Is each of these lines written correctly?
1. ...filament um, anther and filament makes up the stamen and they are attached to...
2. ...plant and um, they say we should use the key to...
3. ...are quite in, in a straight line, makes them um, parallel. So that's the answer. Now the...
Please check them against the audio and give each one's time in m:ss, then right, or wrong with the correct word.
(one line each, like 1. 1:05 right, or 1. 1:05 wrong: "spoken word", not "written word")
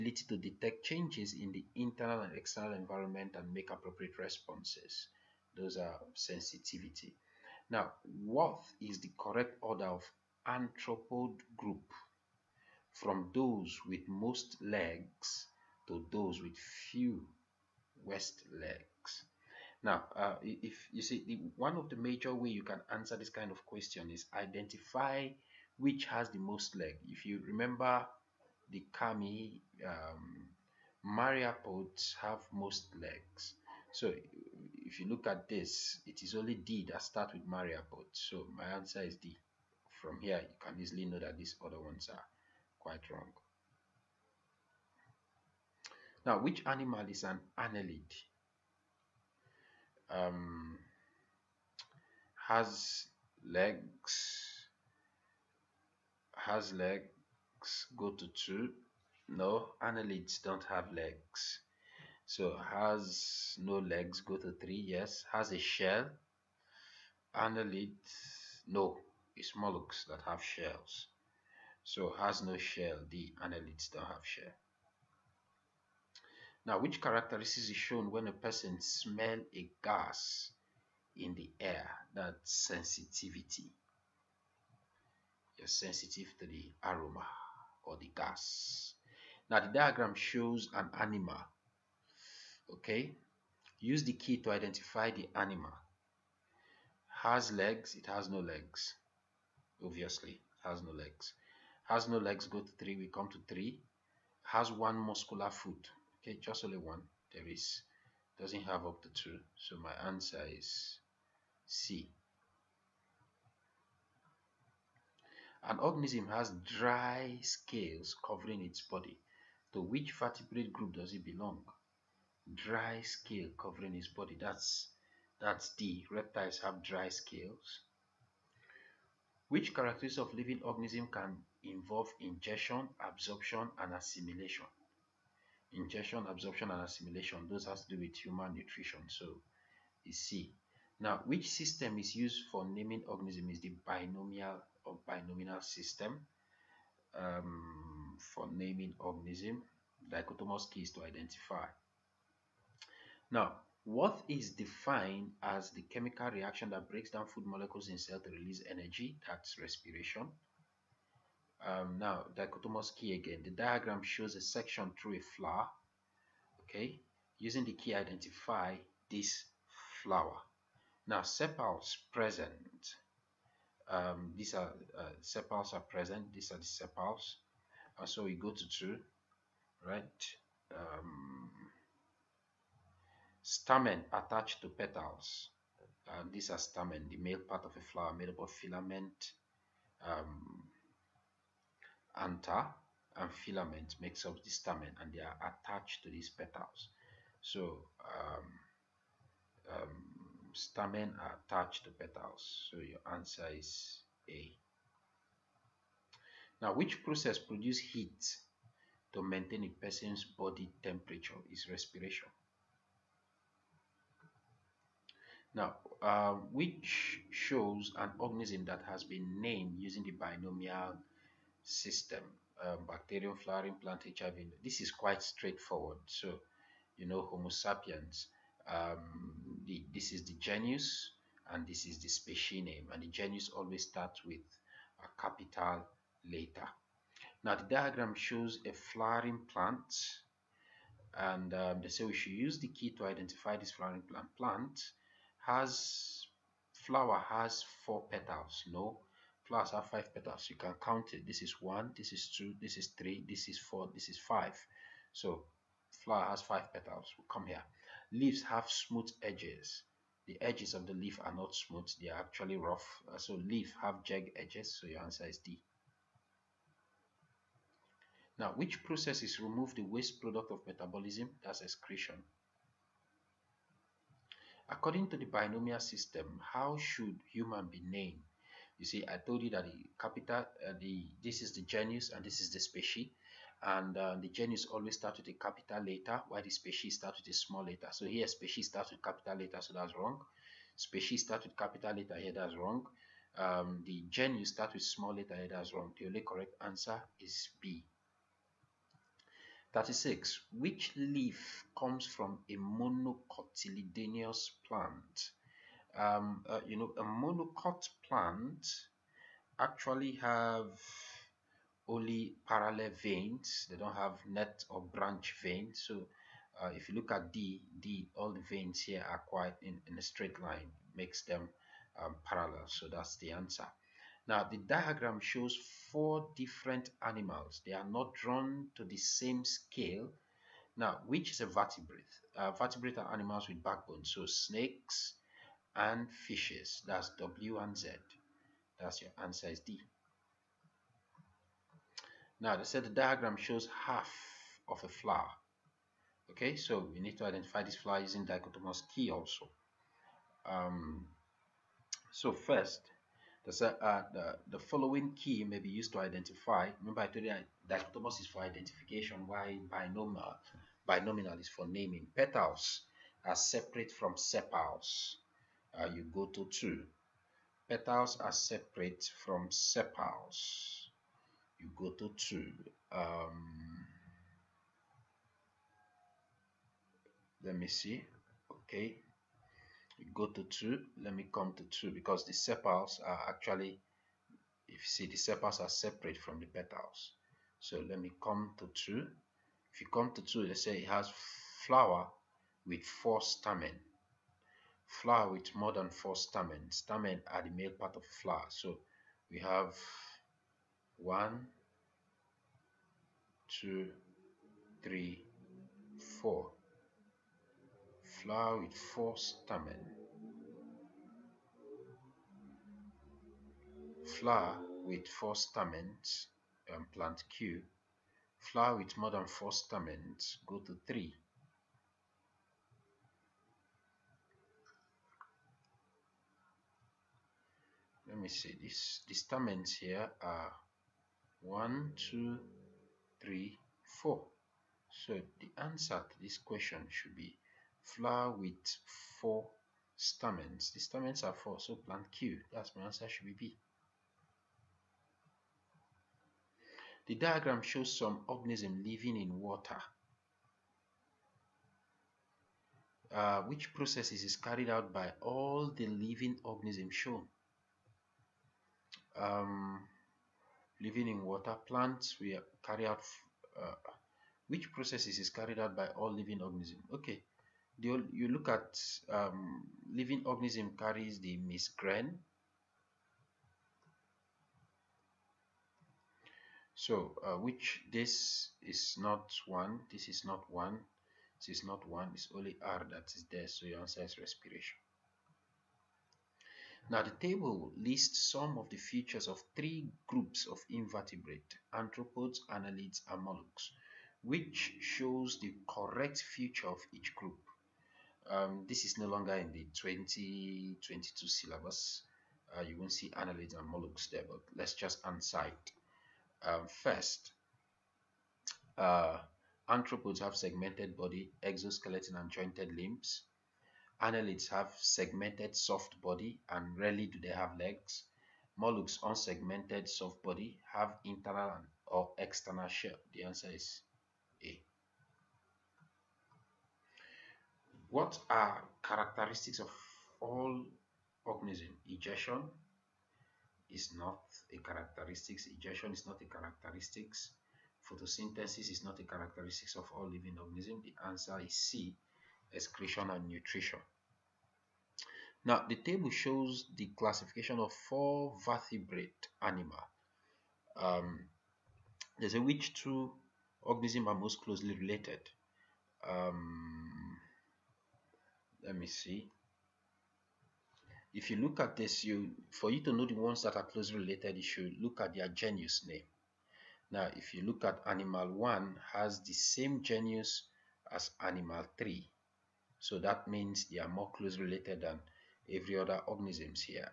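1. 3:08 right
2. 3:59 right
3. 5:19 right.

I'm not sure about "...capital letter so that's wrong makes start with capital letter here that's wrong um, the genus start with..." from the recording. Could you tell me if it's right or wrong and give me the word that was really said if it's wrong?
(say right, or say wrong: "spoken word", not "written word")
wrong: "species", not "makes".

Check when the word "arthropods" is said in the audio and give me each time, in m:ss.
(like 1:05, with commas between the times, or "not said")
8:11, 8:29.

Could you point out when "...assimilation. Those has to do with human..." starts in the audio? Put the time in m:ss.
2:16.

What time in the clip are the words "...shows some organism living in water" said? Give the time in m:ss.
7:27.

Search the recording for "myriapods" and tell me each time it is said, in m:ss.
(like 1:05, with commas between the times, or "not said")
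0:31, 0:37.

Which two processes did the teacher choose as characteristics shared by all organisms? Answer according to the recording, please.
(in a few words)
Excretion and nutrition.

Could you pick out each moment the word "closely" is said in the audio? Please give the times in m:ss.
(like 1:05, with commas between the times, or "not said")
9:14, 9:23, 9:34.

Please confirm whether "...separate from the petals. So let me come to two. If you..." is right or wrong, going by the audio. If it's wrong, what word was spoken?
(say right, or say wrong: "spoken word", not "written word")
right.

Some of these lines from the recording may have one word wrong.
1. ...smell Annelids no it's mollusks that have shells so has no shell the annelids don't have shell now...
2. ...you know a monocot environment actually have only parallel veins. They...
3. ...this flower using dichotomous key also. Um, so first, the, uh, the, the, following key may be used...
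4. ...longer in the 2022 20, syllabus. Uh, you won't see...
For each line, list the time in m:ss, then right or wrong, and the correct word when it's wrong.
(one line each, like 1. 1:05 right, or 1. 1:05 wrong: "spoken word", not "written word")
1. 1:05 wrong: "shell", not "smell"
2. 5:06 wrong: "plant", not "environment"
3. 5:47 right
4. 8:19 right.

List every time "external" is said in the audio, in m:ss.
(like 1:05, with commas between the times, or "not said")
0:02, 8:42.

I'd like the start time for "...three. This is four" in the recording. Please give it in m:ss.
4:12.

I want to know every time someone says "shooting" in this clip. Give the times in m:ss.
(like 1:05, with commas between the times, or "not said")
not said.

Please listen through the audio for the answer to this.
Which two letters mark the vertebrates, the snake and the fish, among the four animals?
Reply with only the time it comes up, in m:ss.
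5:37.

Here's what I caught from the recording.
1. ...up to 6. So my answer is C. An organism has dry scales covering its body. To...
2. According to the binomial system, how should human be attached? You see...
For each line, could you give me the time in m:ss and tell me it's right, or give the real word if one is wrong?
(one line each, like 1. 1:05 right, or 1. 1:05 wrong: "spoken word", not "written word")
1. 1:48 wrong: "2", not "6"
2. 4:34 wrong: "named", not "attached".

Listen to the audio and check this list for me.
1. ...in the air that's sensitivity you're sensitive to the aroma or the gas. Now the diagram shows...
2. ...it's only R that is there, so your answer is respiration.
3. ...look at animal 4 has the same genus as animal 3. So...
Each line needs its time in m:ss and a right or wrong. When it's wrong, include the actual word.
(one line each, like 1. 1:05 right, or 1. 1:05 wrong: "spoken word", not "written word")
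1. 1:21 right
2. 8:02 right
3. 9:27 wrong: "1", not "4".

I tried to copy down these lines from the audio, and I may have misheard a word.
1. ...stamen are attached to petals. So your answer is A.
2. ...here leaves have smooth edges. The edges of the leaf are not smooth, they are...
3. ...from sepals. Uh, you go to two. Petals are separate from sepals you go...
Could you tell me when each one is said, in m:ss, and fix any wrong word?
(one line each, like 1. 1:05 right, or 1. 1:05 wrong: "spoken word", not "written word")
1. 3:20 right
2. 4:17 right
3. 6:03 right.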